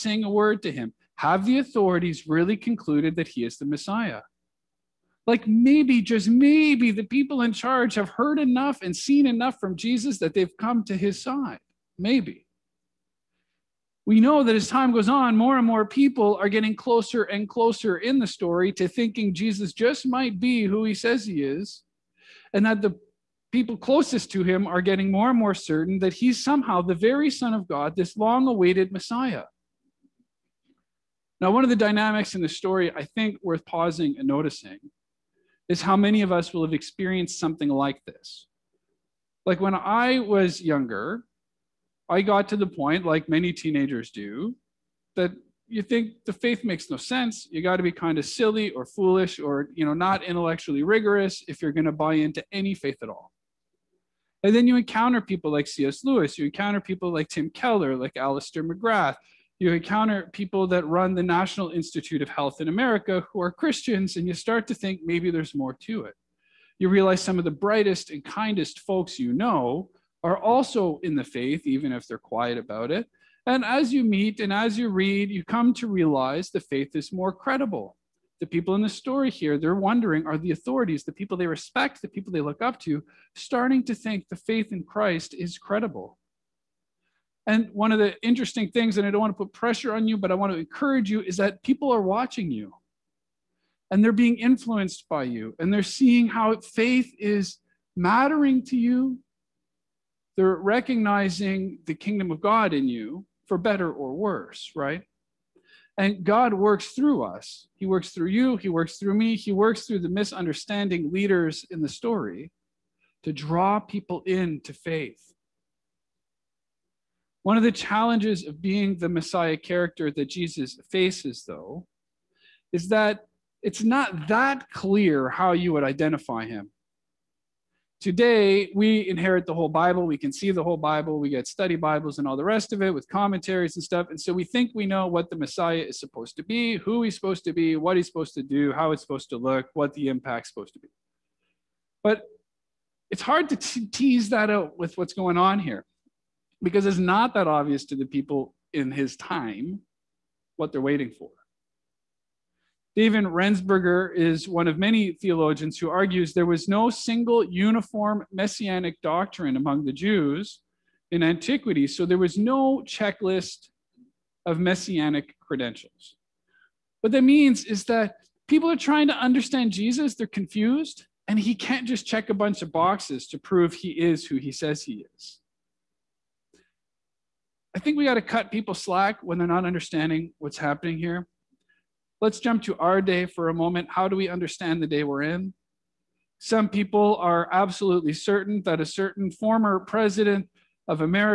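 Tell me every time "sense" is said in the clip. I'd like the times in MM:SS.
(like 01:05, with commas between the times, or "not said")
00:46.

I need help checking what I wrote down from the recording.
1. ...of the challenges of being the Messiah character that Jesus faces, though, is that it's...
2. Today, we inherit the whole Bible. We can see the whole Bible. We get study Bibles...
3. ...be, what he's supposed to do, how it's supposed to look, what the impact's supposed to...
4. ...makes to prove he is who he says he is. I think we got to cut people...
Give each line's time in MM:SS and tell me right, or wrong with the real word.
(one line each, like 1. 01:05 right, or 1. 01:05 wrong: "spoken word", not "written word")
1. 01:57 right
2. 02:07 right
3. 02:17 right
4. 02:52 wrong: "boxes", not "makes".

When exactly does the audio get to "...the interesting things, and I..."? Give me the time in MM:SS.
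01:27.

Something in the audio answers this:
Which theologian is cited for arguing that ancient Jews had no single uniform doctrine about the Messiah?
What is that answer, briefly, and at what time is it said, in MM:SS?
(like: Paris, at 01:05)
David Rensberger, at 02:32.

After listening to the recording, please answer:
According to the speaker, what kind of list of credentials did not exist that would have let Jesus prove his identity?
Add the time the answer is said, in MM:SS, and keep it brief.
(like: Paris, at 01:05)
messianic credentials, at 02:44.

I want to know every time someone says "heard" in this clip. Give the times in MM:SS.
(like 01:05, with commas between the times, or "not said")
00:08.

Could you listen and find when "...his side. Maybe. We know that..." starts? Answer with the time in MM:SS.
00:10.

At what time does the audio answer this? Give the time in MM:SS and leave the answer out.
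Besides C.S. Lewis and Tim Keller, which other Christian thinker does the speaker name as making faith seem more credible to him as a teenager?
00:58.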